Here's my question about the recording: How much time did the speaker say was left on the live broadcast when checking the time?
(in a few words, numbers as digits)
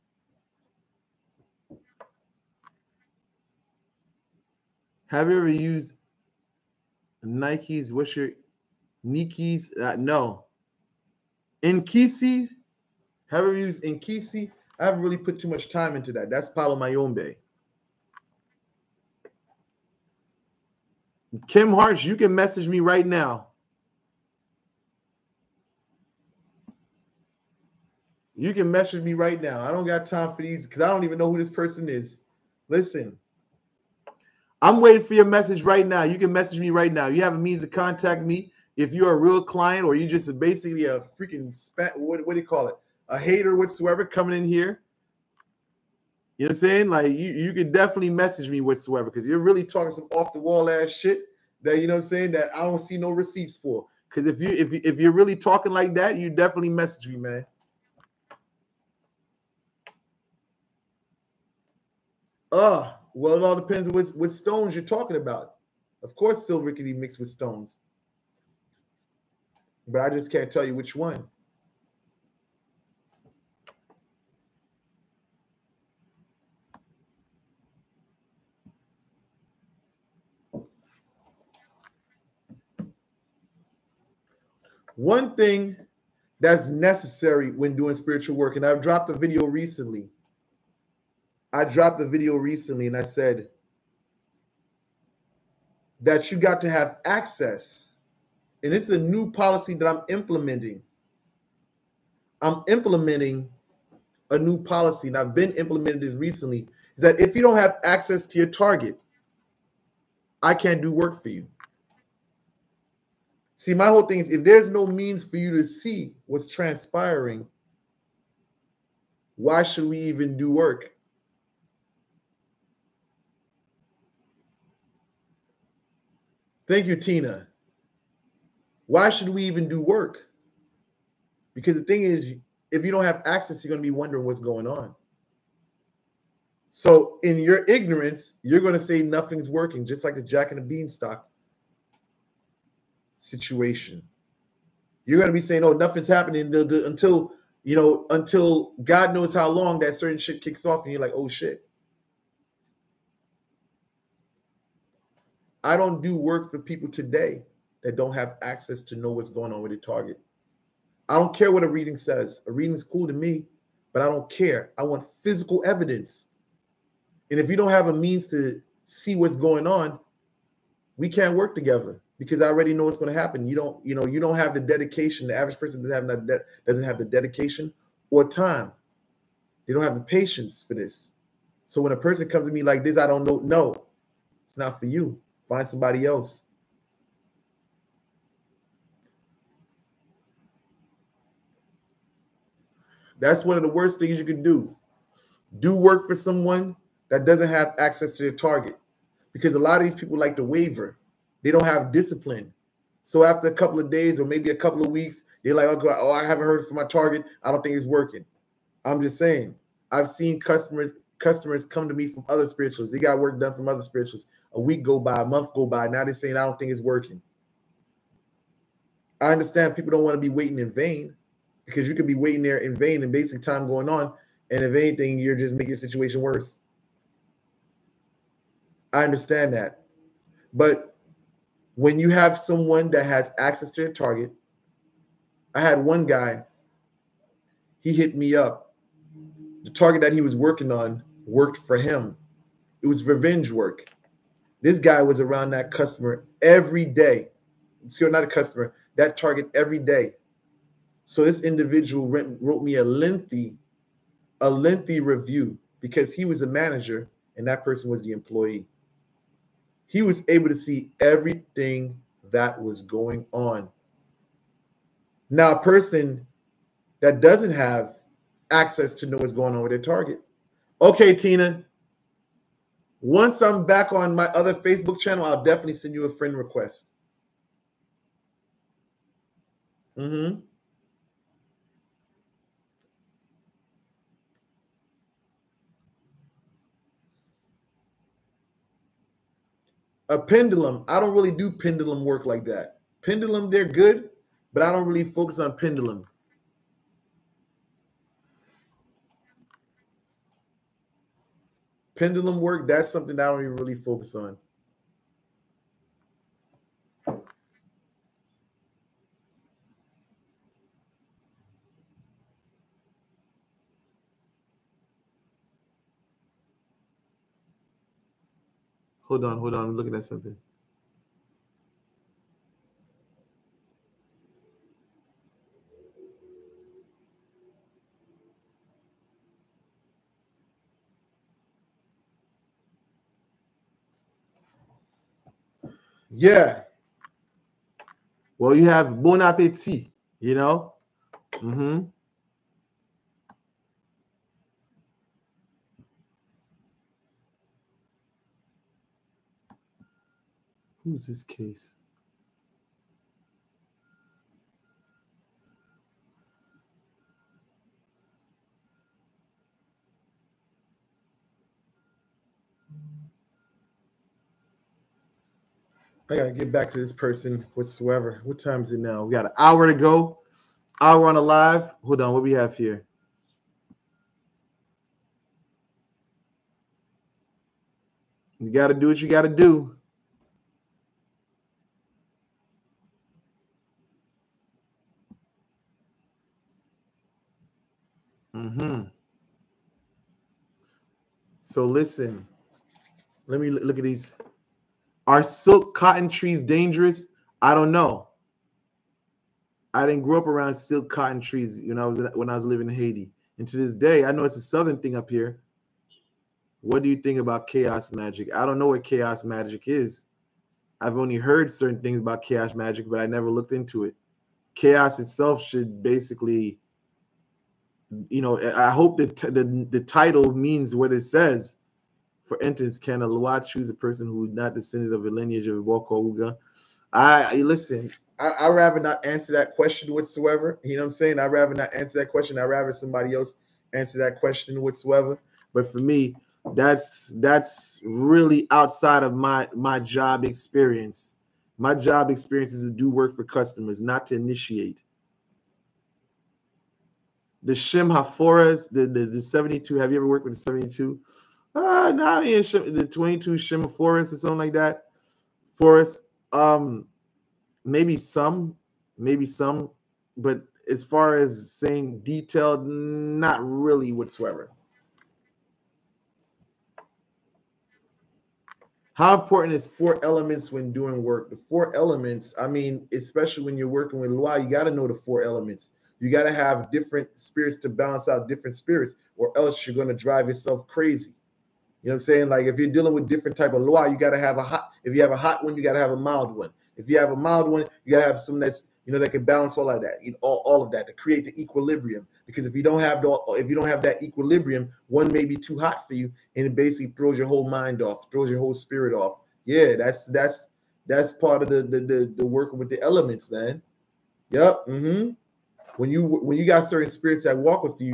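an hour.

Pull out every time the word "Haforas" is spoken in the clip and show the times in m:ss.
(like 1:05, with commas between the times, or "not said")
7:27, 7:33.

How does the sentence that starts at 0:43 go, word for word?
A hater whatsoever coming in here.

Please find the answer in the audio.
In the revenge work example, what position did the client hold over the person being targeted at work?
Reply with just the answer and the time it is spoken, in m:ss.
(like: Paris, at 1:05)
manager, at 4:16.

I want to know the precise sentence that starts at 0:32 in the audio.
Listen, I'm waiting for your message right now.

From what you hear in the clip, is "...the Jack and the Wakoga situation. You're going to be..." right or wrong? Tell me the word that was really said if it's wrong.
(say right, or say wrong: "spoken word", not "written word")
wrong: "Beanstalk", not "Wakoga".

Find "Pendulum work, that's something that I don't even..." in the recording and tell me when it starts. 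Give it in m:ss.
5:01.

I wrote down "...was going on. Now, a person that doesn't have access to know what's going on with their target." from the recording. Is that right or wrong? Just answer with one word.
right.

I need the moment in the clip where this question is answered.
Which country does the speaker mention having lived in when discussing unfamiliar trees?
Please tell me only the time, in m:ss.
6:42.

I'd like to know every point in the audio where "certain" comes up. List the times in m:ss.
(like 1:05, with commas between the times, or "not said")
2:29, 6:51, 8:26.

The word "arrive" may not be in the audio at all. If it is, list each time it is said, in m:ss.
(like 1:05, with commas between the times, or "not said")
not said.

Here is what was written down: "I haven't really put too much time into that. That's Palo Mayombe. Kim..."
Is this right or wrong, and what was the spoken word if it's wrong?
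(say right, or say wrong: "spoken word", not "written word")
right.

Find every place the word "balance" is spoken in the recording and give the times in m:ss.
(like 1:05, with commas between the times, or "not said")
7:57, 8:09.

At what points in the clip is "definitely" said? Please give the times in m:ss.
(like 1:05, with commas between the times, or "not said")
0:47, 0:56, 4:35.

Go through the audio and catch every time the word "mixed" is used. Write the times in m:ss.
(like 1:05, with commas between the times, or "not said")
1:06.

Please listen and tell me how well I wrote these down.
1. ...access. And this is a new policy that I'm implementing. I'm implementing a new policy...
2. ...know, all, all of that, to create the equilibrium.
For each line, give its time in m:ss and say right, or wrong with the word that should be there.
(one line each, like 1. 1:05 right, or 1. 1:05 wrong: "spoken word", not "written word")
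1. 1:37 right
2. 8:10 right.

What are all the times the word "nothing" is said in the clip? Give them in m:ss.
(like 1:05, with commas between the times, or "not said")
2:19, 2:25.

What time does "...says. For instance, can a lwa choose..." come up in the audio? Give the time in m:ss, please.
7:01.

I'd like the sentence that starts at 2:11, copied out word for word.
Because the thing is, if you don't have access, you're going to be wondering what's going on.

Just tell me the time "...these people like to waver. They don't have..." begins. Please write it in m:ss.
3:19.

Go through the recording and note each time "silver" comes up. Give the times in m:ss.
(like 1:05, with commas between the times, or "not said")
1:06.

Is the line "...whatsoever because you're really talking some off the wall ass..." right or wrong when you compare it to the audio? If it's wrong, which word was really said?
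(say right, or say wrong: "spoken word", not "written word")
right.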